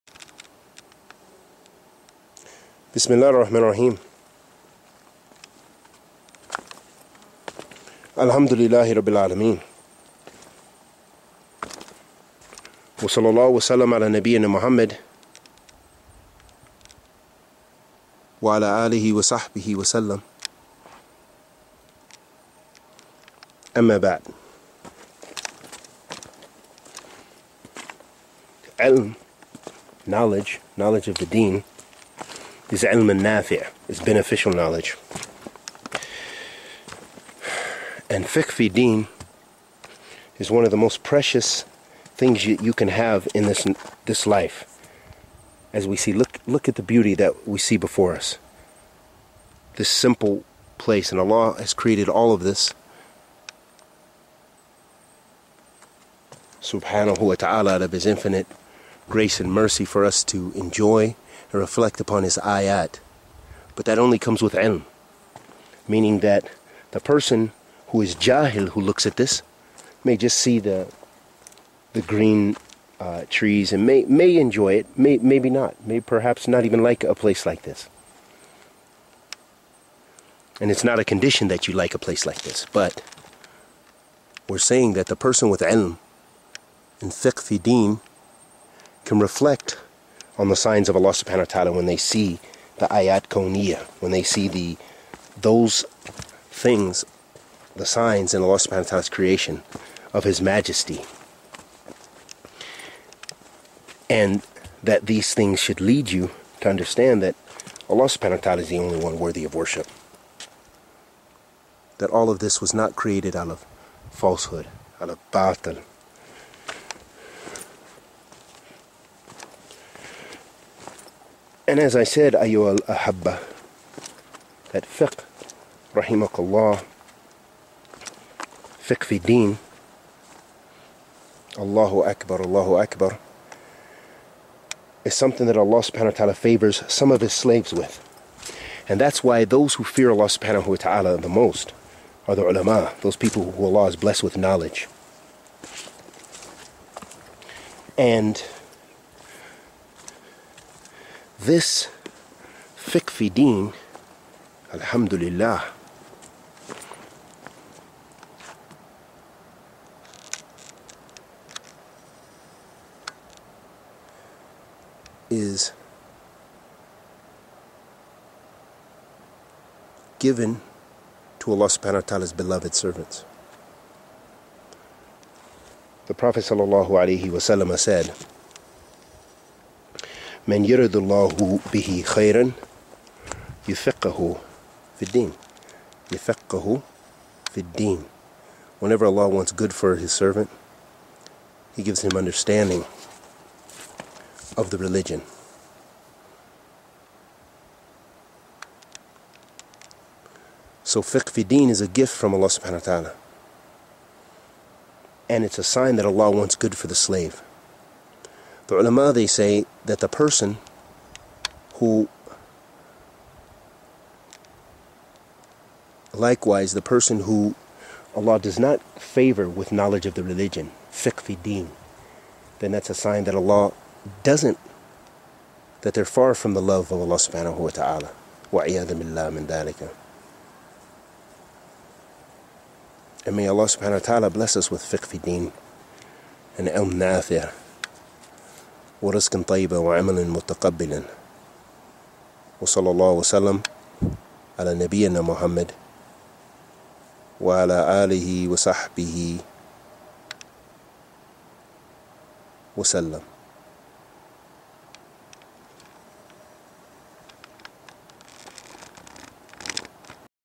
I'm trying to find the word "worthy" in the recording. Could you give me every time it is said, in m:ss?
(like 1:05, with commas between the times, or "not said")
1:49.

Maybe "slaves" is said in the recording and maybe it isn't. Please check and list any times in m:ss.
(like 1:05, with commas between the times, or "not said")
2:17, 3:26.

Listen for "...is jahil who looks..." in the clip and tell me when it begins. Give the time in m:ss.
1:08.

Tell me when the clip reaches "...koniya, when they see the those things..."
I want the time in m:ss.
1:33.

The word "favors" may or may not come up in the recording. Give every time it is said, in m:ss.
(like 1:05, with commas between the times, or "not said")
2:16, 3:38.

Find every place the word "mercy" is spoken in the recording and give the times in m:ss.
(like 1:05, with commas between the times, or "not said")
0:59.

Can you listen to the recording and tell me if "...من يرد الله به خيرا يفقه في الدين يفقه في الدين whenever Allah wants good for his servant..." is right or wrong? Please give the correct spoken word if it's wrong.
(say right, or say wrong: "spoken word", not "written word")
right.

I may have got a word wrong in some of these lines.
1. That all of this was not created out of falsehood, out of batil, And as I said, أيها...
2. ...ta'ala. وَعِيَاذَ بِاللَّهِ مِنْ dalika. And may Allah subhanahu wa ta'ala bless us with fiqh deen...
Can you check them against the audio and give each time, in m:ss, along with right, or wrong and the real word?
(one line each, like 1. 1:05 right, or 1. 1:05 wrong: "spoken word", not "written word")
1. 1:51 right
2. 3:47 right.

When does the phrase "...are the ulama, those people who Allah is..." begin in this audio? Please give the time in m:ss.
2:22.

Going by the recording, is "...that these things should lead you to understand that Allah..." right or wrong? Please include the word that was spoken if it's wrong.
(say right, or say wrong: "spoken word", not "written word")
right.